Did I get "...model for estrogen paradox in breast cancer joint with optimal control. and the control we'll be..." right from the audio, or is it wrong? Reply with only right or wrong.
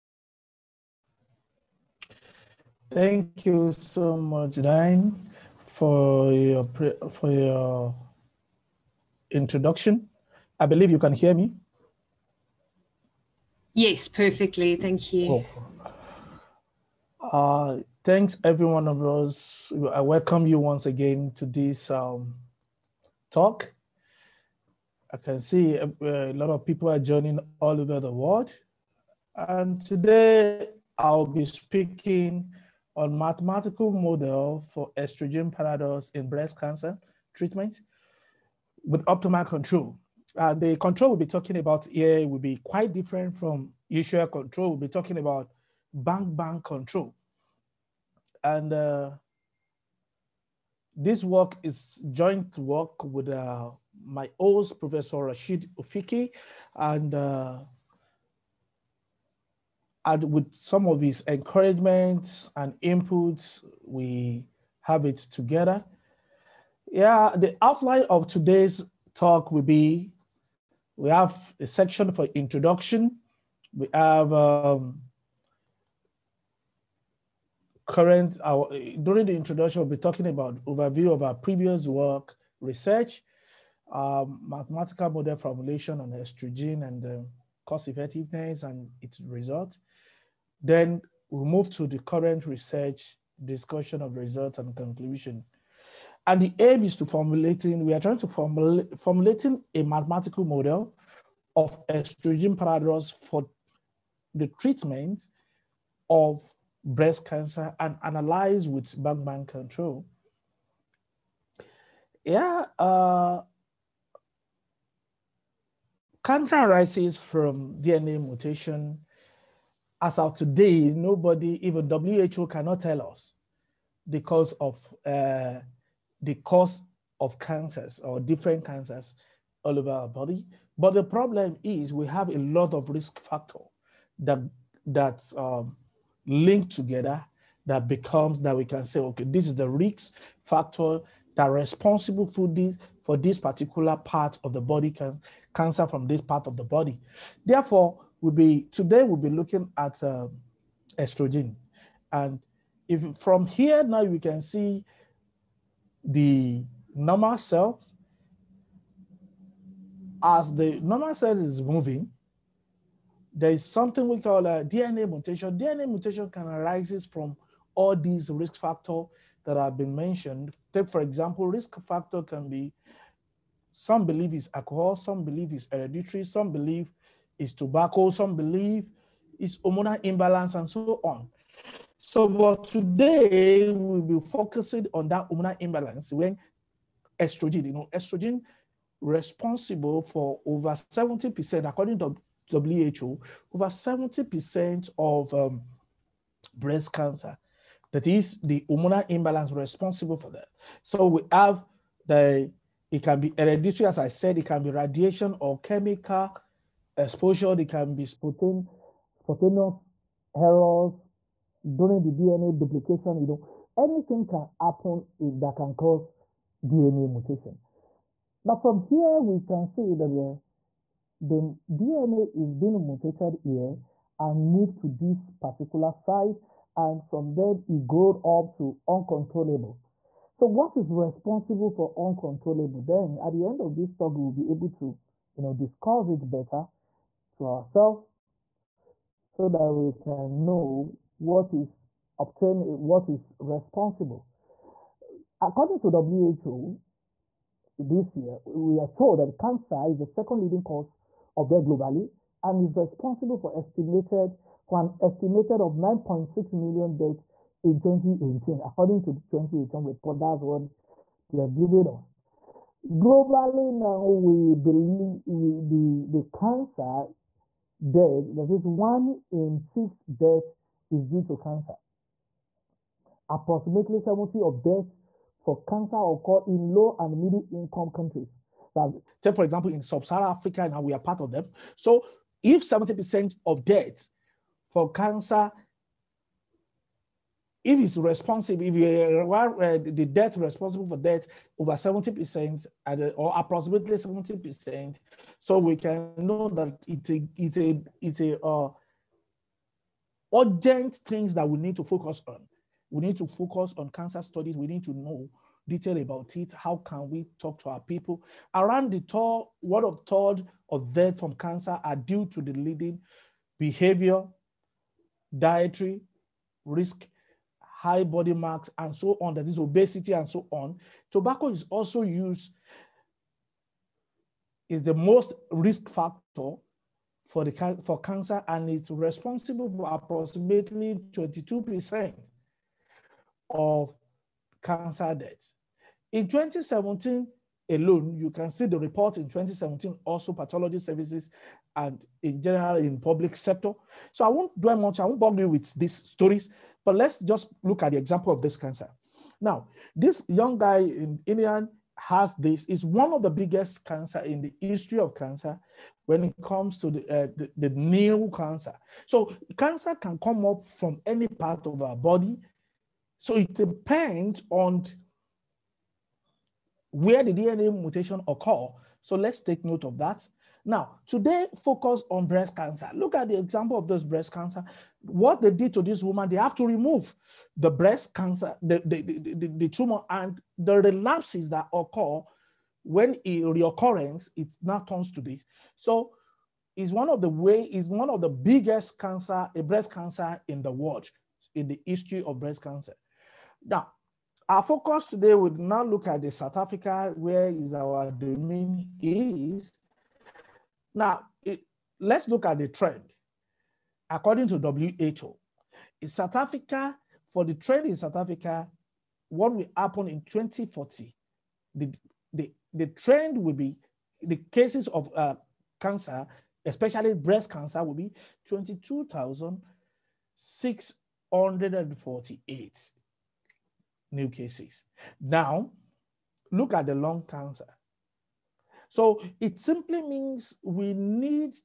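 wrong.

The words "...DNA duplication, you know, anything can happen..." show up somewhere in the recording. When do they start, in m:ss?
3:32.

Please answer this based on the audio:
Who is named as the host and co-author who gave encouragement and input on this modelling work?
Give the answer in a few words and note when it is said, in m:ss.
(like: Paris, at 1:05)
Professor Rachid Ouifki, at 0:54.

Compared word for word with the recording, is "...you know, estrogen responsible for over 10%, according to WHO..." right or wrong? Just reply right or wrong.
wrong.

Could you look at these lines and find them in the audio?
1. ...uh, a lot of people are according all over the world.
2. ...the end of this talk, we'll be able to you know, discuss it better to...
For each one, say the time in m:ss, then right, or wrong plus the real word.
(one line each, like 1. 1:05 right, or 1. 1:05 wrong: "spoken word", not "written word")
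1. 0:26 wrong: "joining", not "according"
2. 3:53 right.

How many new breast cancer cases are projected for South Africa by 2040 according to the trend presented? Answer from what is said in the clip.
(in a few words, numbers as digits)
22,648.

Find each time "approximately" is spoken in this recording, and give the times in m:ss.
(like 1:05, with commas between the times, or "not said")
4:33, 4:53, 5:29.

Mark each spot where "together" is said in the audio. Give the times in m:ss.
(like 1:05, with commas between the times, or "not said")
1:05, 2:16.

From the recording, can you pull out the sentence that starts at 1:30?
Then we move to the current research discussion of results and conclusion.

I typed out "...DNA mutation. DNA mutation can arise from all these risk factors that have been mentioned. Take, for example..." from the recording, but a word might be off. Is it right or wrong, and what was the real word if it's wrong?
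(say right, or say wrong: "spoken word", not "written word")
right.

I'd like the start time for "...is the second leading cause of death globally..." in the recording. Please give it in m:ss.
4:09.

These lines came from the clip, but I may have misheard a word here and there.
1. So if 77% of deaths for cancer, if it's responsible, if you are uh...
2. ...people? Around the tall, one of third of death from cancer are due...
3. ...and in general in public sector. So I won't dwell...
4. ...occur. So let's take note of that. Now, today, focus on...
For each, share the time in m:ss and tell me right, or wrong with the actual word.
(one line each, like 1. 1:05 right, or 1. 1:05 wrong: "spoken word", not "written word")
1. 4:41 wrong: "70", not "77"
2. 5:07 right
3. 5:41 right
4. 6:08 right.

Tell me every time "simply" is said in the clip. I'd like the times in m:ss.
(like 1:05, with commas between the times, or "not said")
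7:09.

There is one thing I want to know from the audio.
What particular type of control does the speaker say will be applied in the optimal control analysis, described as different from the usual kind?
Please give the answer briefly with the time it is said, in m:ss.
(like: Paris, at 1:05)
bang bang control, at 0:45.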